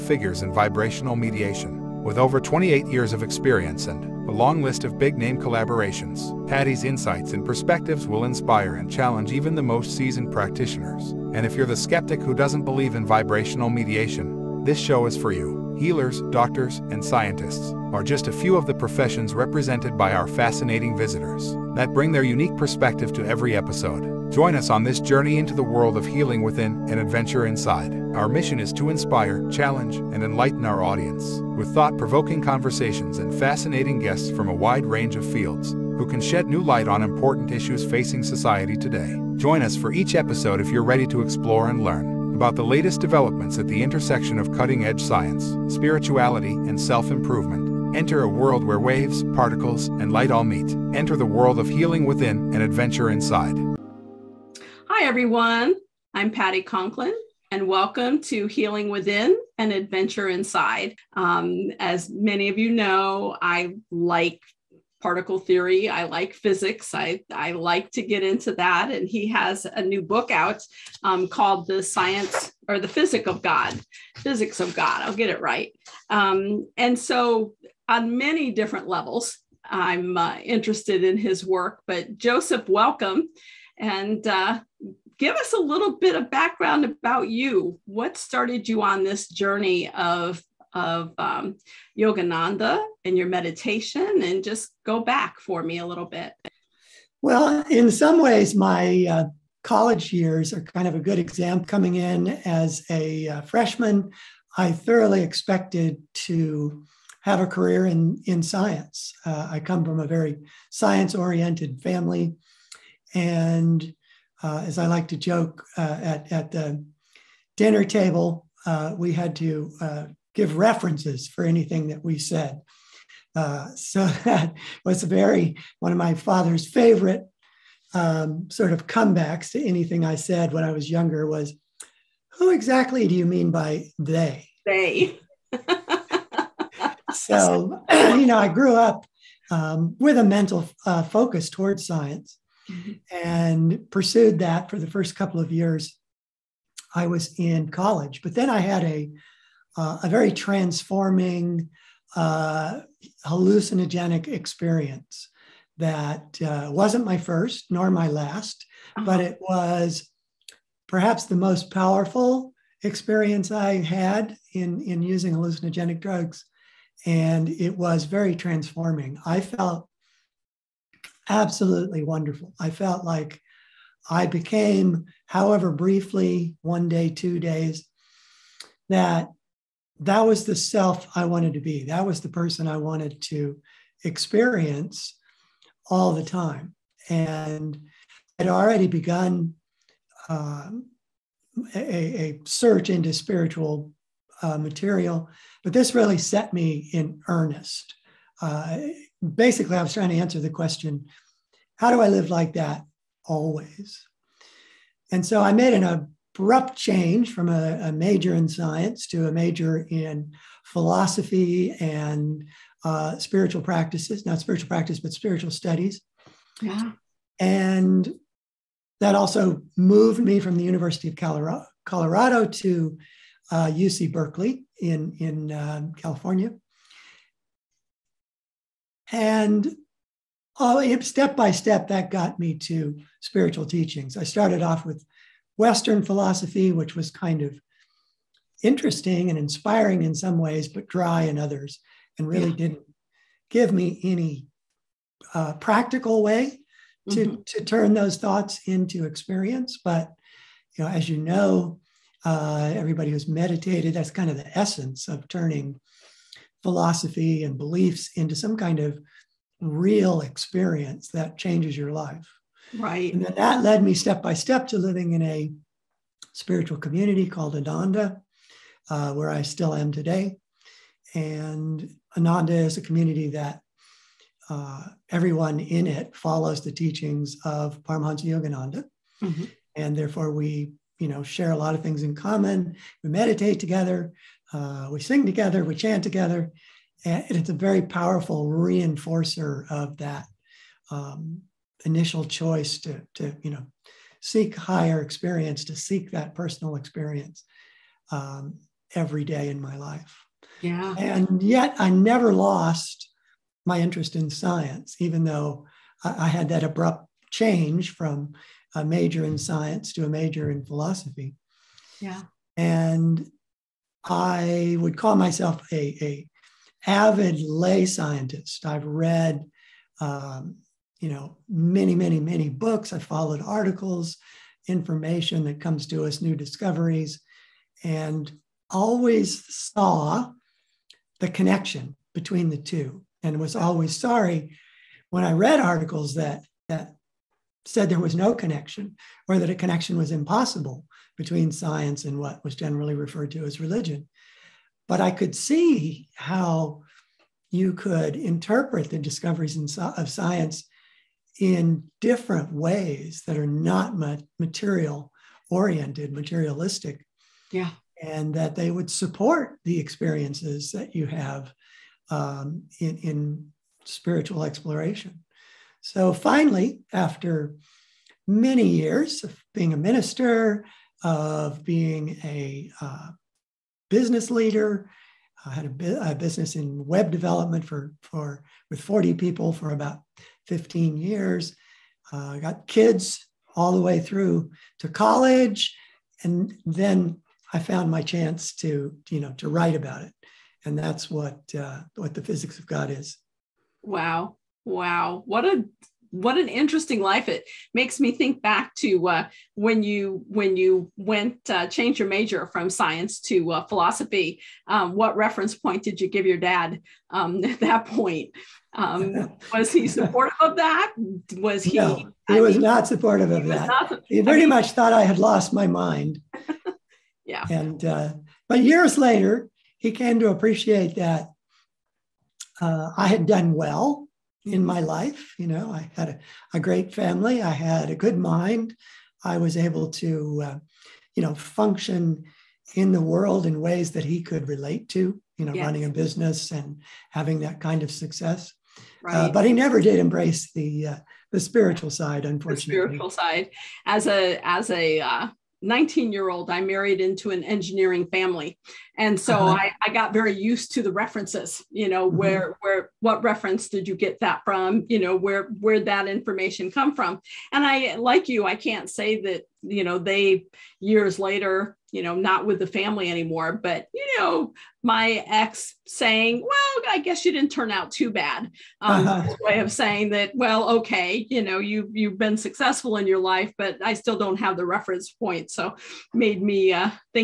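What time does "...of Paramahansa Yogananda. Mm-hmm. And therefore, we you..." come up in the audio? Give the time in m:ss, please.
4:37.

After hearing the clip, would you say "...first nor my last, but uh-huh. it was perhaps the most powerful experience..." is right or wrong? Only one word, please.
right.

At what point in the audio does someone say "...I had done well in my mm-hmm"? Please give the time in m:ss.
7:02.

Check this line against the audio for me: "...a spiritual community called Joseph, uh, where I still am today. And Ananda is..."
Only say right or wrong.
wrong.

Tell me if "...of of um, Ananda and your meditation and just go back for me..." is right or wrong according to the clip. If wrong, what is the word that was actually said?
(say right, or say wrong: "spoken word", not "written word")
wrong: "Yogananda", not "Ananda".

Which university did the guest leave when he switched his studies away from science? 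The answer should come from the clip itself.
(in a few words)
University of Colorado.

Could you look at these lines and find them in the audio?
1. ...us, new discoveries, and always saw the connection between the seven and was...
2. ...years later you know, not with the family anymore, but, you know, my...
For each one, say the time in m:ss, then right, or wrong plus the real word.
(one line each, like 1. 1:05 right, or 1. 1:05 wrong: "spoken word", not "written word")
1. 5:26 wrong: "two", not "seven"
2. 7:40 right.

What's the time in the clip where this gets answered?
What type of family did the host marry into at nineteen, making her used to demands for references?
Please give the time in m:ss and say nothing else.
7:27.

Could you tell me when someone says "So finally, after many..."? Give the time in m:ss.
6:05.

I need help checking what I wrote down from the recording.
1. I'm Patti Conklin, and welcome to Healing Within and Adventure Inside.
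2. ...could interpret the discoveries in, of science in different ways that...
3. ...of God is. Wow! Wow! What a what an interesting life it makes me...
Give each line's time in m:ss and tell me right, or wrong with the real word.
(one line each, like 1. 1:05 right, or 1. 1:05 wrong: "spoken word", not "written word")
1. 0:56 right
2. 5:47 right
3. 6:32 right.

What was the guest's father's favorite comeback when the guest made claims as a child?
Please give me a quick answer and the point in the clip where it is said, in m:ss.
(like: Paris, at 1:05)
Who exactly do you mean by they?, at 2:12.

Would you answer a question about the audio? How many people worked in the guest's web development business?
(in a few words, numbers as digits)
40.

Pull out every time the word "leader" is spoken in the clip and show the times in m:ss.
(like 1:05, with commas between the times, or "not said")
6:14.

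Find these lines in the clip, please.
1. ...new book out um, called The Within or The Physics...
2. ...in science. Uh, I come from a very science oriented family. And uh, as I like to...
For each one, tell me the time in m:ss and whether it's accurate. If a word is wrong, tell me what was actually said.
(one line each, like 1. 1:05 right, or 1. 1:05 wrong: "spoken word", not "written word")
1. 1:09 wrong: "Science", not "Within"
2. 1:48 right.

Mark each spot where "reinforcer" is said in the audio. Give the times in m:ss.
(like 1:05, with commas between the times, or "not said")
4:48.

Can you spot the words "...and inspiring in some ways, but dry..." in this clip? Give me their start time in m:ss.
3:59.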